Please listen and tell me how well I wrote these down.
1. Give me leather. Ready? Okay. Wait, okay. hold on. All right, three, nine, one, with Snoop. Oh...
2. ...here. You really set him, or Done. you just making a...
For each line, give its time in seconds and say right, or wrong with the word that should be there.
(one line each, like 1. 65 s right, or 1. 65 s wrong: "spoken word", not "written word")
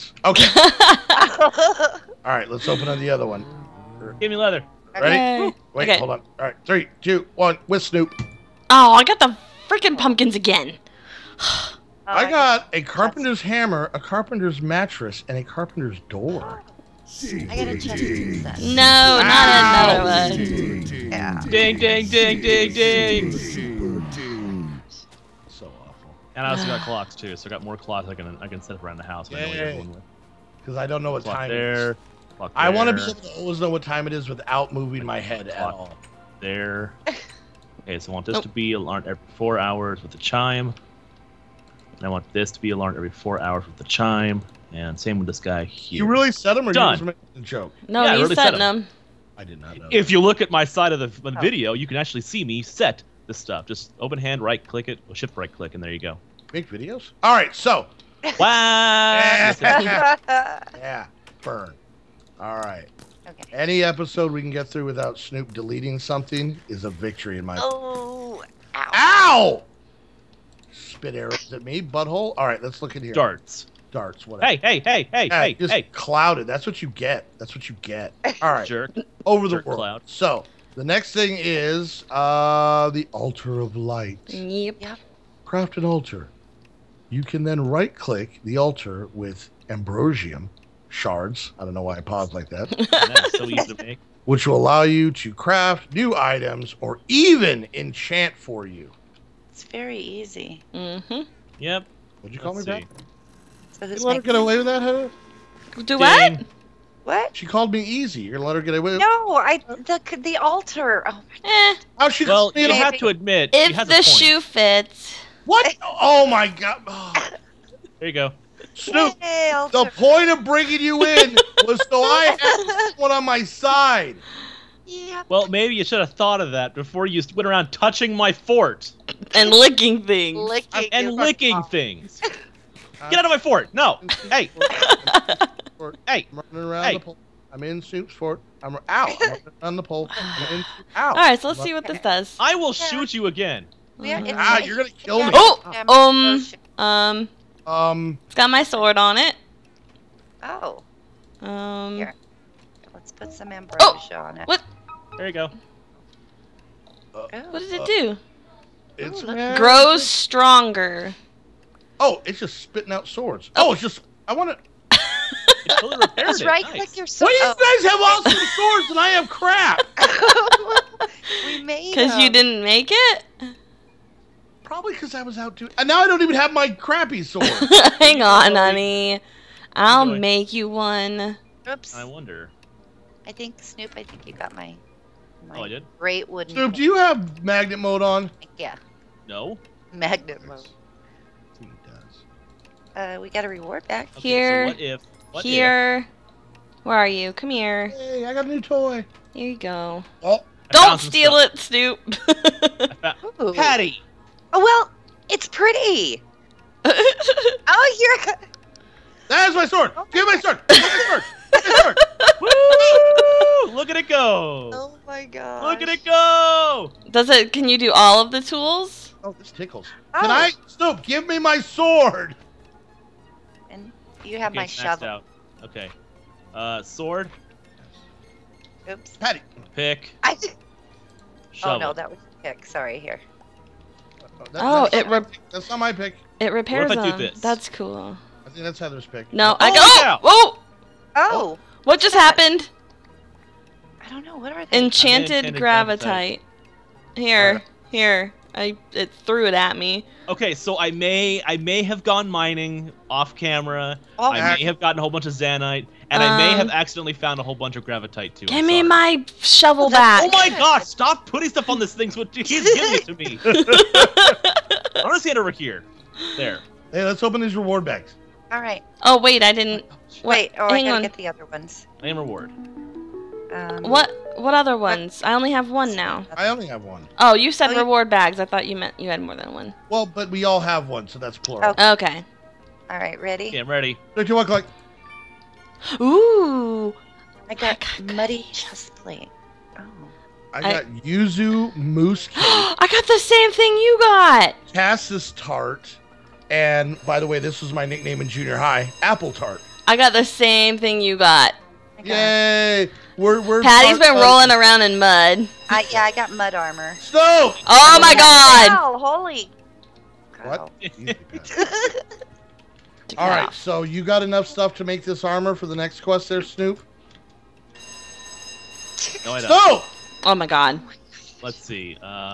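1. 4 s wrong: "two", not "nine"
2. 45 s right.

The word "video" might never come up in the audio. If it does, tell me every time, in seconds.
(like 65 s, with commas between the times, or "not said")
51 s, 56 s.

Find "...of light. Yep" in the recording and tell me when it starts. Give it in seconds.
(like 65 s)
83 s.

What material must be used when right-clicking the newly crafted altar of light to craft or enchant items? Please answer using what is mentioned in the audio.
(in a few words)
Ambrosium shards.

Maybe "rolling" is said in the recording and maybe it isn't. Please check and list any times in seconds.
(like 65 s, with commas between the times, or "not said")
304 s.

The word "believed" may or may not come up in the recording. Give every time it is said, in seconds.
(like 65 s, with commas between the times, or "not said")
not said.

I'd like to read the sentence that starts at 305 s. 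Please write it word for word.
I, yeah, I got mud armor.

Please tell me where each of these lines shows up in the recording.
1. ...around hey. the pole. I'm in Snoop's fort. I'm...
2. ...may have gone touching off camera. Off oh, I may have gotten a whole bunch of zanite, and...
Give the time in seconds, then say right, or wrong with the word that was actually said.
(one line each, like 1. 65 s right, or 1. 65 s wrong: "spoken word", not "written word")
1. 136 s right
2. 251 s wrong: "mining", not "touching".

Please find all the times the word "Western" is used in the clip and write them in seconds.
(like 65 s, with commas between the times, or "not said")
not said.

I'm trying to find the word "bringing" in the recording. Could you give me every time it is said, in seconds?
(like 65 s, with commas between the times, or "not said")
120 s.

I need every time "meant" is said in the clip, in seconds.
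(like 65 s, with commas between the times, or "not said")
278 s.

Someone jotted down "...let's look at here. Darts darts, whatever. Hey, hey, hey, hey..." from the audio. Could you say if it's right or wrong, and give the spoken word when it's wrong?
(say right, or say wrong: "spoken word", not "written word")
right.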